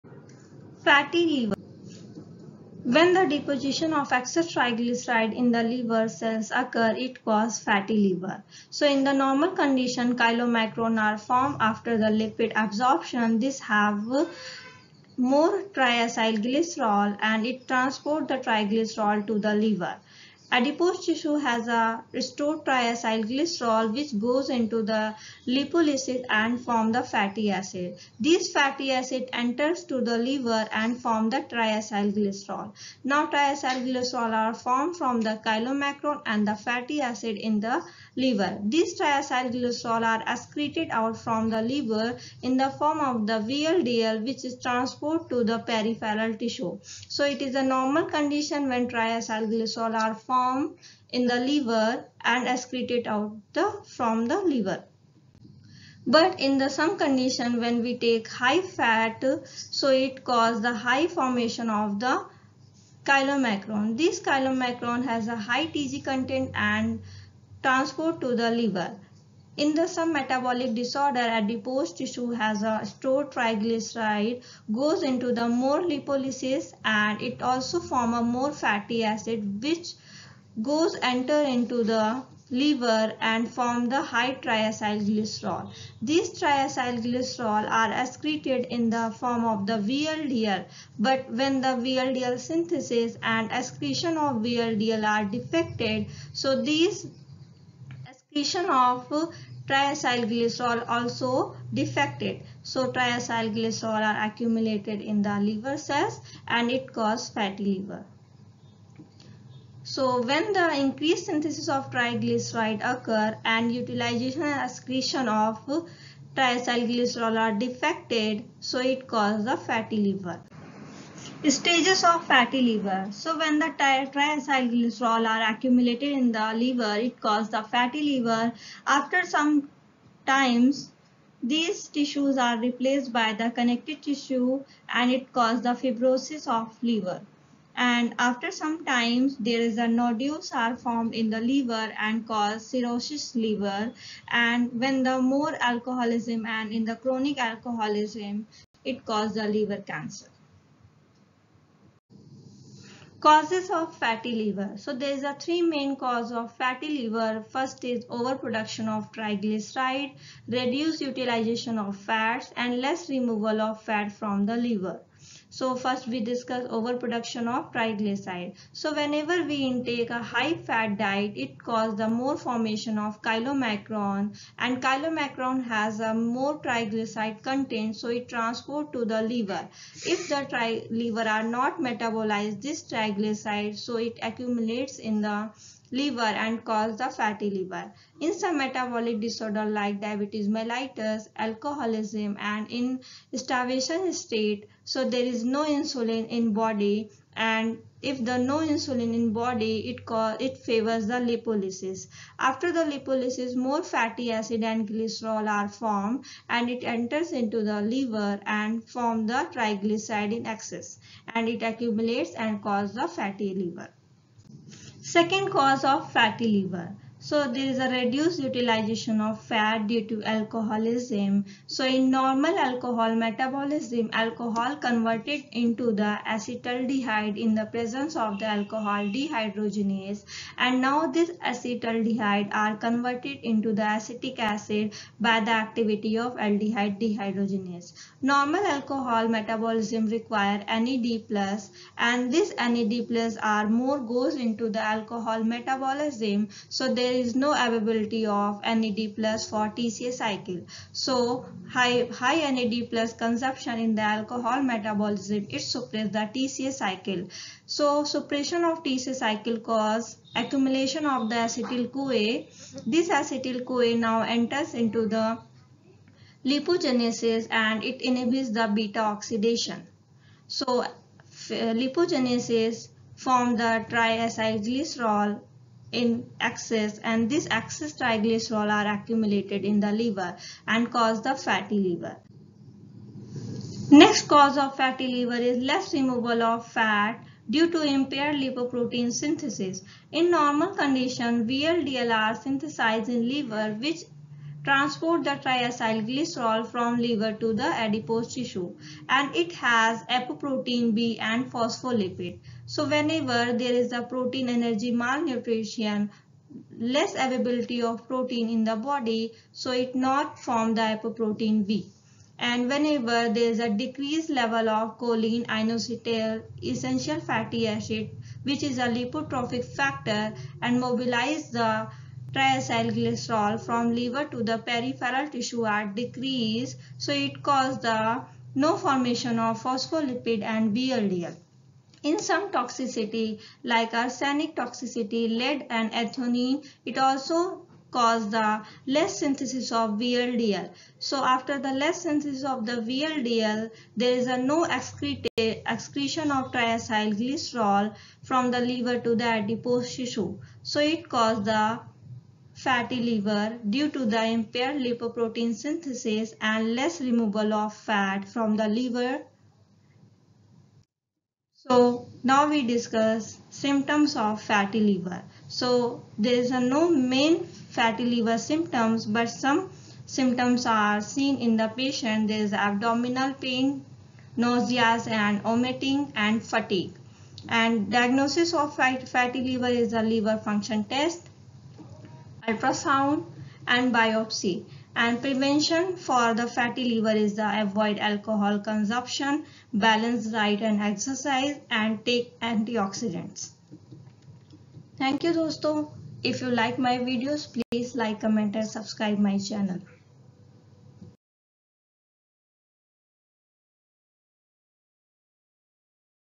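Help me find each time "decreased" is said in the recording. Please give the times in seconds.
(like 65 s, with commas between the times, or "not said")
313 s, 325 s.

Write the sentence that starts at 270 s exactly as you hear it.
So lipogenesis form the triacylglycerol in excess and this excess triglycerol are accumulated in the liver and cause the fatty liver.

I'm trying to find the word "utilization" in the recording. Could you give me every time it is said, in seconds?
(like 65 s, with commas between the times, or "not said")
113 s, 161 s, 218 s.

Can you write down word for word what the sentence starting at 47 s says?
So it is a normal condition when triacylglycerol are formed form in the liver and it out the from the liver.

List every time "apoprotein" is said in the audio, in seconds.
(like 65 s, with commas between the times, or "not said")
300 s, 310 s.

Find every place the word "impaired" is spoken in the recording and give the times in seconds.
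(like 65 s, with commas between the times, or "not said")
287 s, 354 s.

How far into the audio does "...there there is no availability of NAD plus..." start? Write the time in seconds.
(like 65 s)
246 s.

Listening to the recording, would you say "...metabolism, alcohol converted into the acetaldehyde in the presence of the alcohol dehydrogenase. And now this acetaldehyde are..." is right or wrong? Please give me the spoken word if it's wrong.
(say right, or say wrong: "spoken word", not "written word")
right.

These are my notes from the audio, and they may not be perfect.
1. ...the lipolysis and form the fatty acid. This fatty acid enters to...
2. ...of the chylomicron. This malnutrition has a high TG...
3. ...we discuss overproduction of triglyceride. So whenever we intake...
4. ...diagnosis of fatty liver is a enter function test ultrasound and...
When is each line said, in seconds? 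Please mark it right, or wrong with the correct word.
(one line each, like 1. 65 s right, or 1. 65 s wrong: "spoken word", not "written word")
1. 24 s right
2. 61 s wrong: "chylomicron", not "malnutrition"
3. 166 s right
4. 377 s wrong: "liver", not "enter".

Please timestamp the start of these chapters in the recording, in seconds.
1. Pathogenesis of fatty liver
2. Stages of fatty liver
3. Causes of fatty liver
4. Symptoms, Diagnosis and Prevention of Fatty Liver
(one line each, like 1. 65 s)
1. 55 s
2. 121 s
3. 155 s
4. 361 s.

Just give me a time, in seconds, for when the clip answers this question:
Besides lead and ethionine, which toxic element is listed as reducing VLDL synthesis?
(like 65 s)
333 s.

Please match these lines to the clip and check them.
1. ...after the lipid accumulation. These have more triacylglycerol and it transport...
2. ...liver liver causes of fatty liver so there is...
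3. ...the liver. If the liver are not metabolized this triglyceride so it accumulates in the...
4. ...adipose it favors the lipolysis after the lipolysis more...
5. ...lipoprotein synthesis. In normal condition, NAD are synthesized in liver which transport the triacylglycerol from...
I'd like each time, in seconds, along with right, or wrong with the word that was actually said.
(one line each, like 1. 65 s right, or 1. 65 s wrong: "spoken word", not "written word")
1. 11 s wrong: "absorption", not "accumulation"
2. 149 s wrong: "cancer", not "liver"
3. 179 s right
4. 200 s wrong: "cause", not "adipose"
5. 288 s wrong: "VLDL", not "NAD".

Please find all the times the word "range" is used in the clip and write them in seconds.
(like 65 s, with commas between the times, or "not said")
not said.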